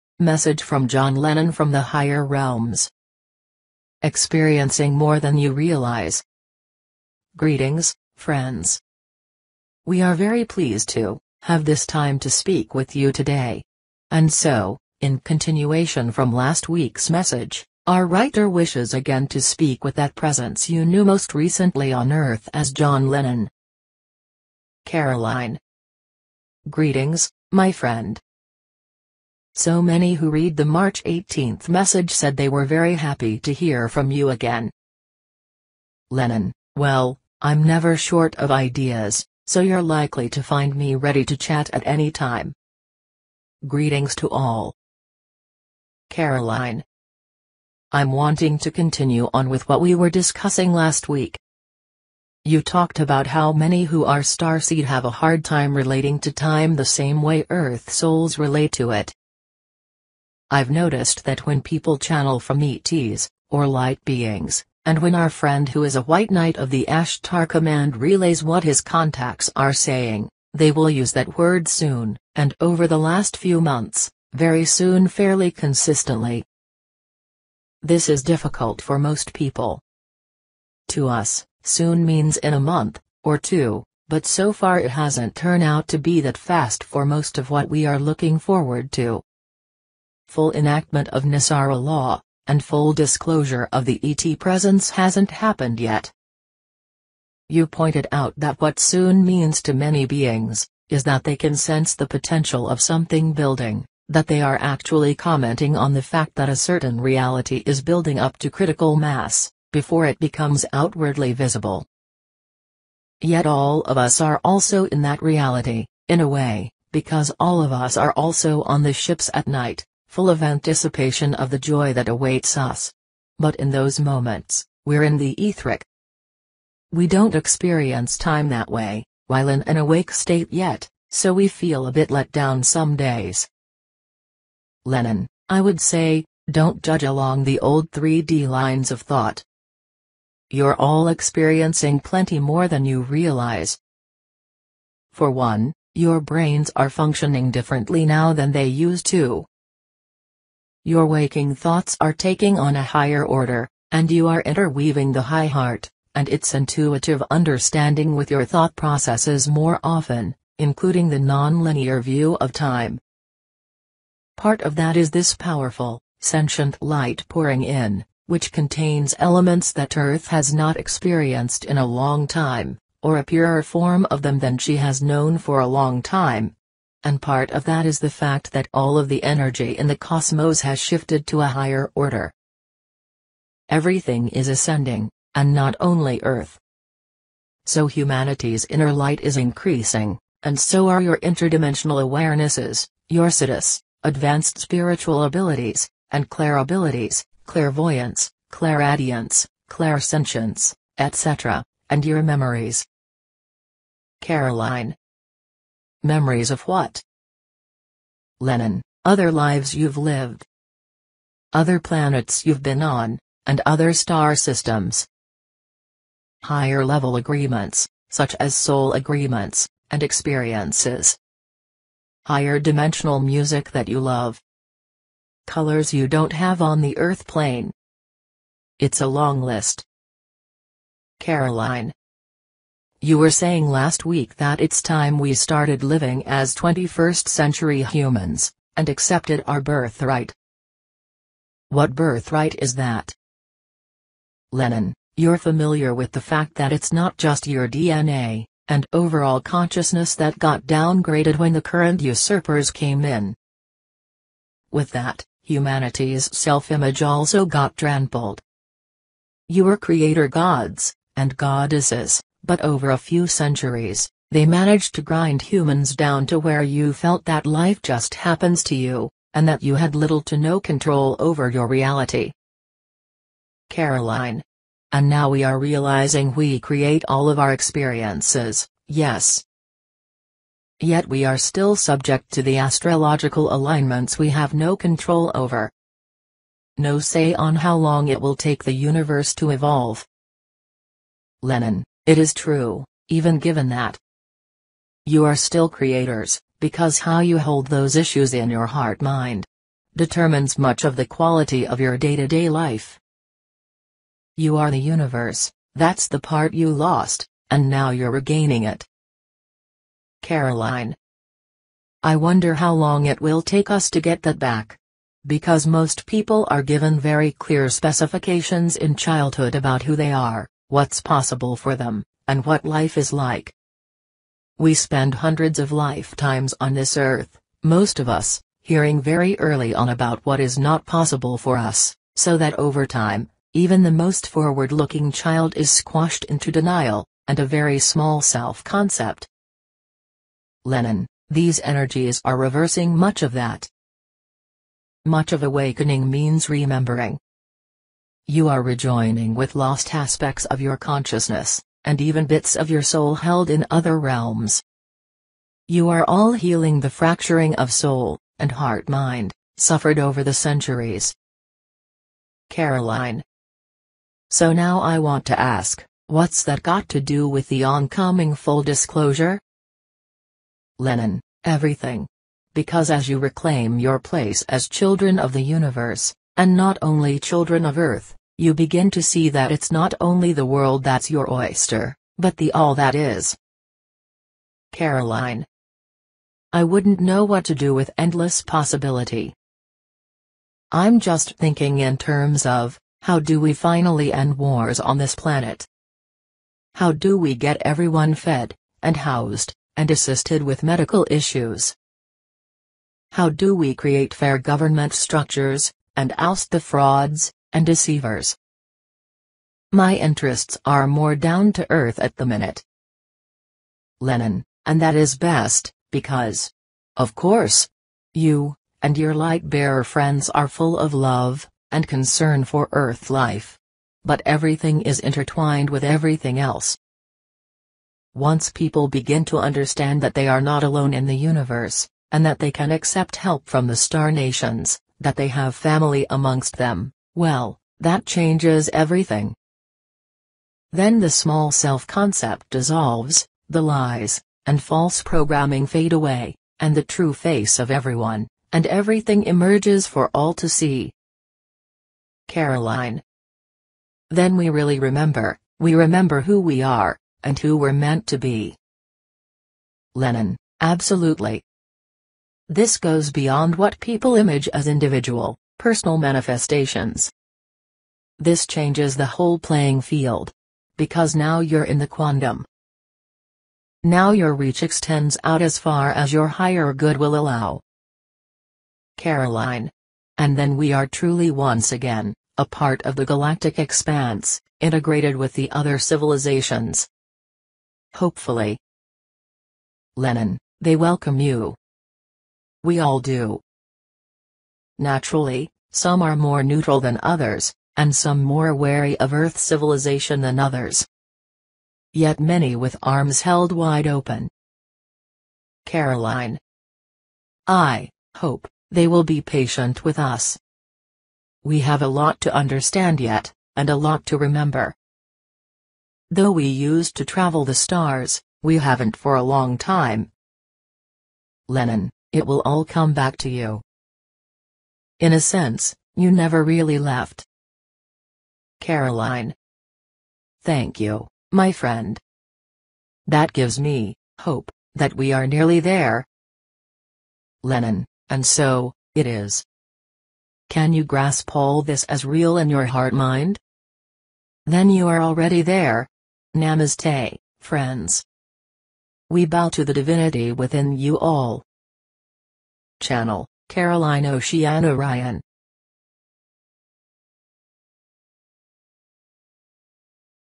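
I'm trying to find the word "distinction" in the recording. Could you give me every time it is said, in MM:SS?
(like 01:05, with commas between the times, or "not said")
not said.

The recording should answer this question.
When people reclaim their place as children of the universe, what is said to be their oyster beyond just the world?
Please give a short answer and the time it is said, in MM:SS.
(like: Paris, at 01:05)
the all that is, at 06:22.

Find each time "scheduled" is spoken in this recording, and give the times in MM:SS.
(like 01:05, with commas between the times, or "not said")
not said.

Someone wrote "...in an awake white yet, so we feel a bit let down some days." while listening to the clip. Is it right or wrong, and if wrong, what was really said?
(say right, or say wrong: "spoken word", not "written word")
wrong: "state", not "white".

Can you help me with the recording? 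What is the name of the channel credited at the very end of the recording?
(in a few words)
Caroline Oceana Ryan.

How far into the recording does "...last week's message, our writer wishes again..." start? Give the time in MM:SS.
00:16.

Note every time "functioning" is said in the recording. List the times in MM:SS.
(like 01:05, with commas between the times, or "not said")
02:26.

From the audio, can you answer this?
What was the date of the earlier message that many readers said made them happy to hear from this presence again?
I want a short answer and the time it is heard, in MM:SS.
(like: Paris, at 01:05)
March 18th, at 00:30.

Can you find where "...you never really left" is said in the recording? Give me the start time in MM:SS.
08:45.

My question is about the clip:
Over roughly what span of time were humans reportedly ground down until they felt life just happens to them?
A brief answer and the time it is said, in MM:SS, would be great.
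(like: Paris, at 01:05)
a few centuries, at 04:22.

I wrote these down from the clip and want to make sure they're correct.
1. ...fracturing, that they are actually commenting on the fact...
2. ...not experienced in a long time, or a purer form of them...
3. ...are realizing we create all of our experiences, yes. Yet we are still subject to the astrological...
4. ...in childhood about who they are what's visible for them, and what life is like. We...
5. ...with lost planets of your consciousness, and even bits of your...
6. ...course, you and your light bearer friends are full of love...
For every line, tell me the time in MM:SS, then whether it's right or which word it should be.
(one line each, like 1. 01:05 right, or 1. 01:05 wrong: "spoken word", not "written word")
1. 01:43 wrong: "building", not "fracturing"
2. 02:50 right
3. 04:35 right
4. 05:18 wrong: "possible", not "visible"
5. 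05:49 wrong: "aspects", not "planets"
6. 06:57 right.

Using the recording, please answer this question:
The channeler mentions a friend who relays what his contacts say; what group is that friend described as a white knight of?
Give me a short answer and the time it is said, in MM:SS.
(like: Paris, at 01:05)
Ashtar command, at 01:06.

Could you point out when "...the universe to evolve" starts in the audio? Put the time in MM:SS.
04:48.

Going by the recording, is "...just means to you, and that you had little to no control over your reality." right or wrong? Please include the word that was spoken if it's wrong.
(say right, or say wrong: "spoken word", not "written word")
wrong: "happens", not "means".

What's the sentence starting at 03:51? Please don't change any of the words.
Caroline, you were saying last week that it's time we started living as 21st century humans, and accepted our birthright.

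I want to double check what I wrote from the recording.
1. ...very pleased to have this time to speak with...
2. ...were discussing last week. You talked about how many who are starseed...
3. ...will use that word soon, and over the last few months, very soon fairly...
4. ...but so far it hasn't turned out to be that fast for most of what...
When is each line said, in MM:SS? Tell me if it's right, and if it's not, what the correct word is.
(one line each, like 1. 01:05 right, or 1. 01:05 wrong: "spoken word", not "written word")
1. 00:10 right
2. 00:49 right
3. 01:10 right
4. 01:24 right.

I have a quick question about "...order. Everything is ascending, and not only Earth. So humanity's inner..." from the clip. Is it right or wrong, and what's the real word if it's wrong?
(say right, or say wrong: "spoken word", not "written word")
right.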